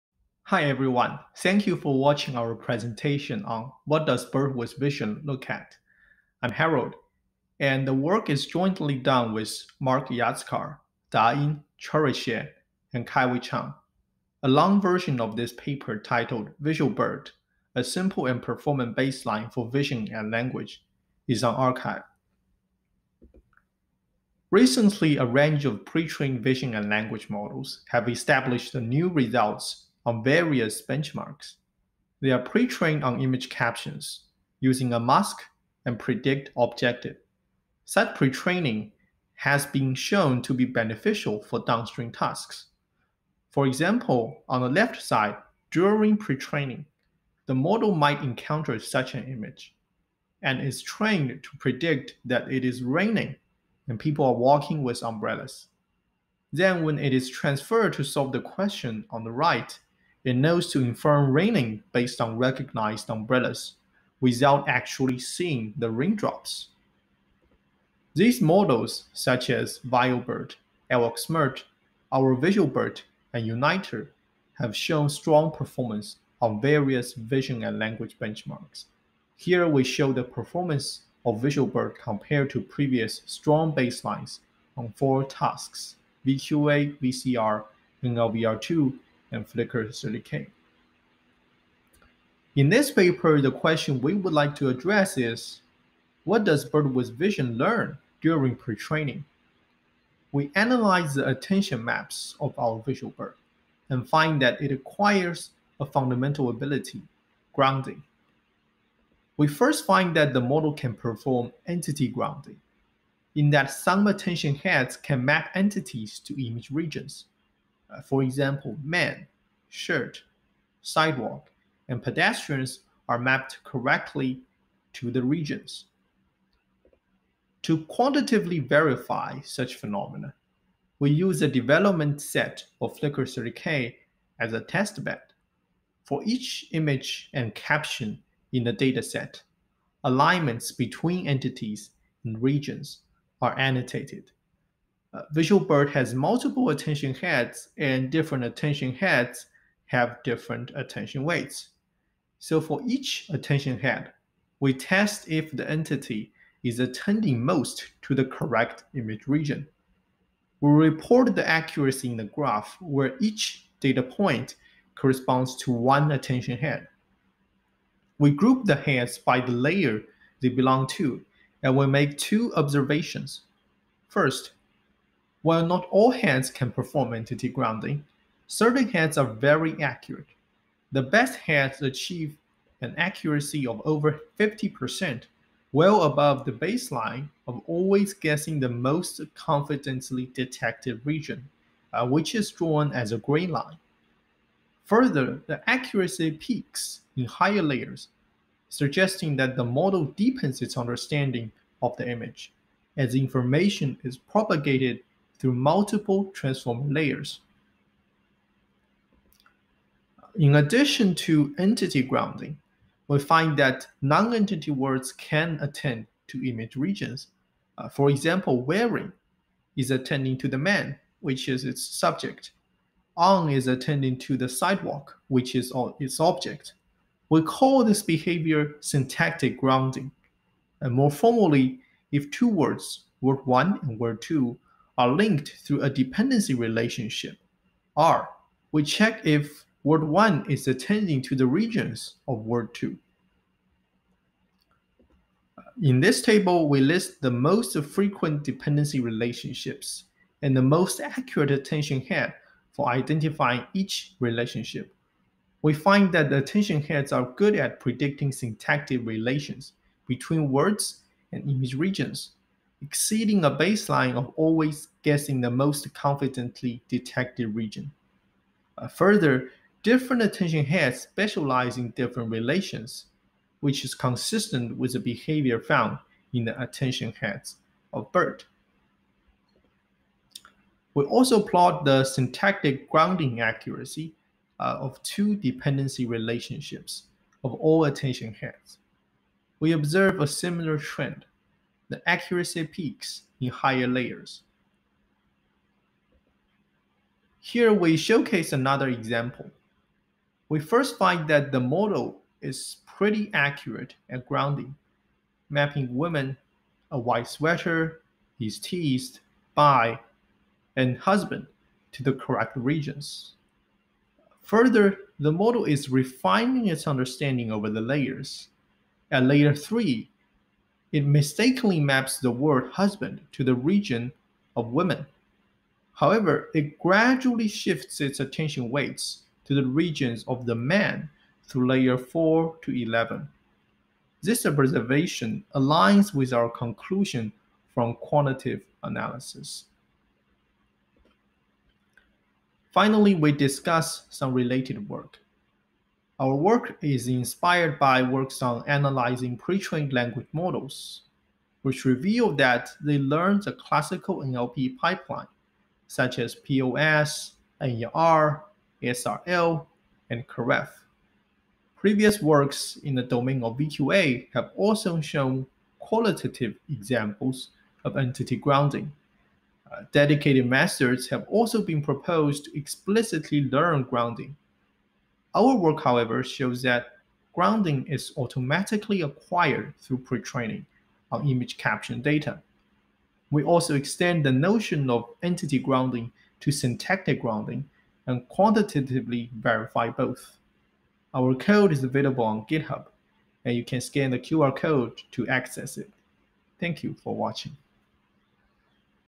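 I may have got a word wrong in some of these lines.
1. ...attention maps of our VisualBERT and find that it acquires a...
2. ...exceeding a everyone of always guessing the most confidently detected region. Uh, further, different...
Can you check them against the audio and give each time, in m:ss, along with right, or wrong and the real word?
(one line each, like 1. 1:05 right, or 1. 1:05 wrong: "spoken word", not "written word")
1. 1:41 right
2. 4:22 wrong: "baseline", not "everyone".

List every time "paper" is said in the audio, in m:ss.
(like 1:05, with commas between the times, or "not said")
0:15, 1:32.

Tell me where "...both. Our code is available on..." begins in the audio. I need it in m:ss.
6:29.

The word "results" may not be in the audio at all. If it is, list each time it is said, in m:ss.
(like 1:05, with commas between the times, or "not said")
0:29.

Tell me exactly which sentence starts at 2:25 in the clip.
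Uh, VisualBERT has multiple attention heads, and different attention heads have different attention weights.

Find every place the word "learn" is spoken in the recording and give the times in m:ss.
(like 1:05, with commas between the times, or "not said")
1:37, 5:52, 6:13.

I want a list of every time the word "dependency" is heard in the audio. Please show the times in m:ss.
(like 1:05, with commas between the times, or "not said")
3:55, 4:08, 4:45.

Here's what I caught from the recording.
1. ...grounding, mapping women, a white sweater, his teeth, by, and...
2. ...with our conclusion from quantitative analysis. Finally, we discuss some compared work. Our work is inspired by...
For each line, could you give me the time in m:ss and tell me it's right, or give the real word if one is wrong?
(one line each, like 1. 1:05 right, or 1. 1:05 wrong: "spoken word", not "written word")
1. 5:04 right
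2. 5:36 wrong: "related", not "compared".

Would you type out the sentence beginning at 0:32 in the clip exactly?
They are pre-trained on image captions using a mask and predict objective.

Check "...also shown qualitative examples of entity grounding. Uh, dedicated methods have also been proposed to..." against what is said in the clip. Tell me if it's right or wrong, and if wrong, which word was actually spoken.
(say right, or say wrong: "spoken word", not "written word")
right.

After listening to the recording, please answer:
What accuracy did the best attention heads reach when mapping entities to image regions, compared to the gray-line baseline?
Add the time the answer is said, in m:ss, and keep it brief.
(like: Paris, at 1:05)
over 50%, at 3:03.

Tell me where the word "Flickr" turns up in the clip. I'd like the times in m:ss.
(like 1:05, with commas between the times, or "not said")
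1:29, 2:12.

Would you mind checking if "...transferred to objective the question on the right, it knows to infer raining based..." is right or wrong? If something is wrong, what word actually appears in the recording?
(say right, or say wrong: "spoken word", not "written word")
wrong: "solve", not "objective".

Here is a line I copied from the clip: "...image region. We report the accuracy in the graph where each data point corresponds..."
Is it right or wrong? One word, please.
right.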